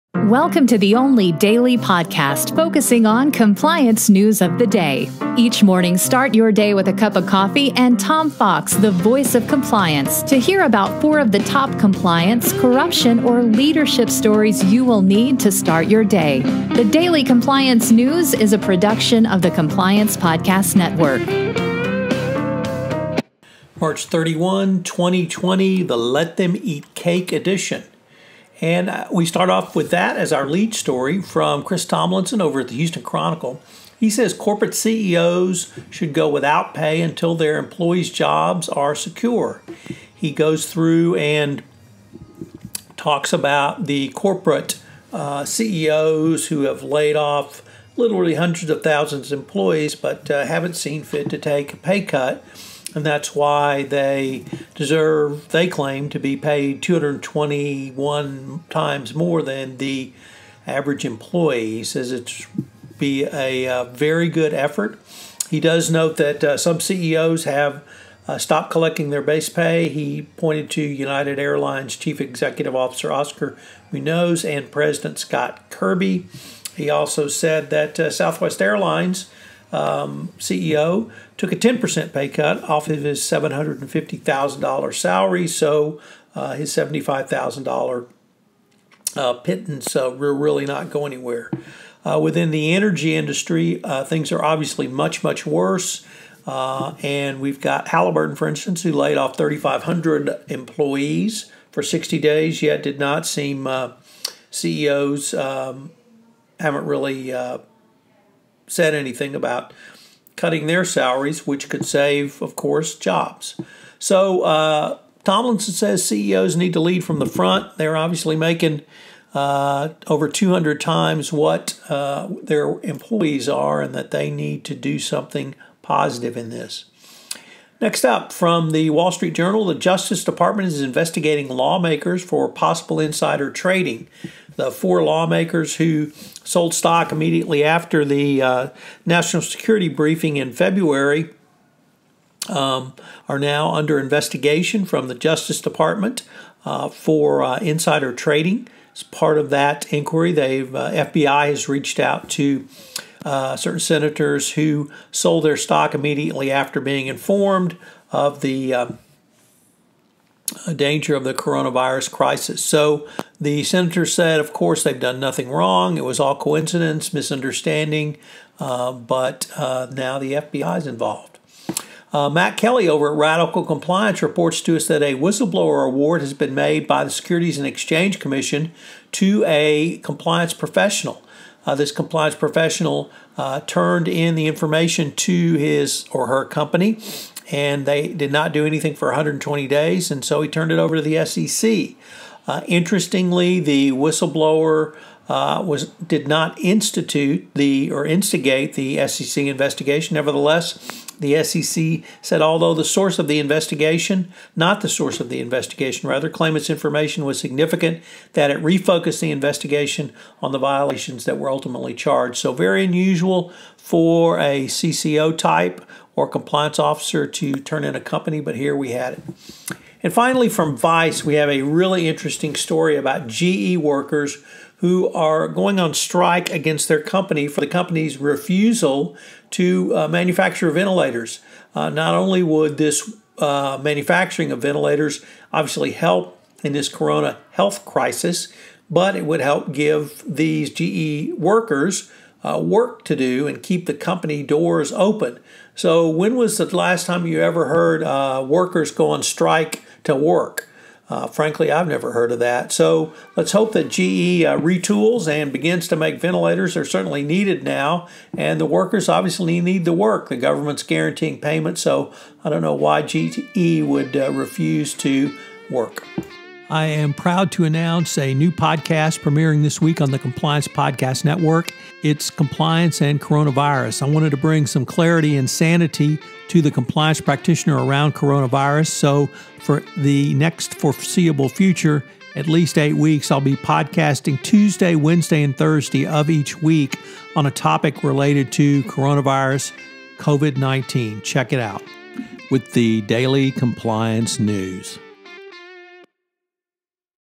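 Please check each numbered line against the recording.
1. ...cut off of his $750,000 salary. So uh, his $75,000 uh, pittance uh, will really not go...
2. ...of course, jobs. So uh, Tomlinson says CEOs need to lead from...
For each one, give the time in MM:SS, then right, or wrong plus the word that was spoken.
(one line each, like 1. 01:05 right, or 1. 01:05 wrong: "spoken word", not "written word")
1. 01:22 right
2. 01:52 right.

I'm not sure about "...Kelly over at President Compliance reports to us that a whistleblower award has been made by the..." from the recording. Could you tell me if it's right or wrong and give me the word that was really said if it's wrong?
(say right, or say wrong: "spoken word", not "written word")
wrong: "Radical", not "President".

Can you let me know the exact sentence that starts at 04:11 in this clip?
Uh, frankly, I've never heard of that.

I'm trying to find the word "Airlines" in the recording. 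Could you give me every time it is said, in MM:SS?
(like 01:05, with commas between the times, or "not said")
01:11, 01:18.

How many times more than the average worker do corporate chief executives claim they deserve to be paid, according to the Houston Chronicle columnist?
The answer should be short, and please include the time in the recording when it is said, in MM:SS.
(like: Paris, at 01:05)
221, at 00:56.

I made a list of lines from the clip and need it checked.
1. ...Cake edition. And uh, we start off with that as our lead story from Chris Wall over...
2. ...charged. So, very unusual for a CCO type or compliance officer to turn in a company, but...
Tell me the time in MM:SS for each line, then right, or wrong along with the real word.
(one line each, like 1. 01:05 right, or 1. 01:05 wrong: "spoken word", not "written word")
1. 00:26 wrong: "Tomlinson", not "Wall"
2. 03:31 right.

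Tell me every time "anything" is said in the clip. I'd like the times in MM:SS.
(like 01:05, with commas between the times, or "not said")
01:48, 03:08.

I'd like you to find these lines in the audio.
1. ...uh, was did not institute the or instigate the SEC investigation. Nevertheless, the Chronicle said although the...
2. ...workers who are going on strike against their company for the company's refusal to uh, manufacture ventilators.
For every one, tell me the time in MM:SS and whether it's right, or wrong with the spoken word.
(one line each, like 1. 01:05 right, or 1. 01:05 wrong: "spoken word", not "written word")
1. 03:15 wrong: "SEC", not "Chronicle"
2. 03:43 right.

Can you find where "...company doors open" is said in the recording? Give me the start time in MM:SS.
04:03.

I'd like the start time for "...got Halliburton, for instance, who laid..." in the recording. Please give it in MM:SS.
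01:37.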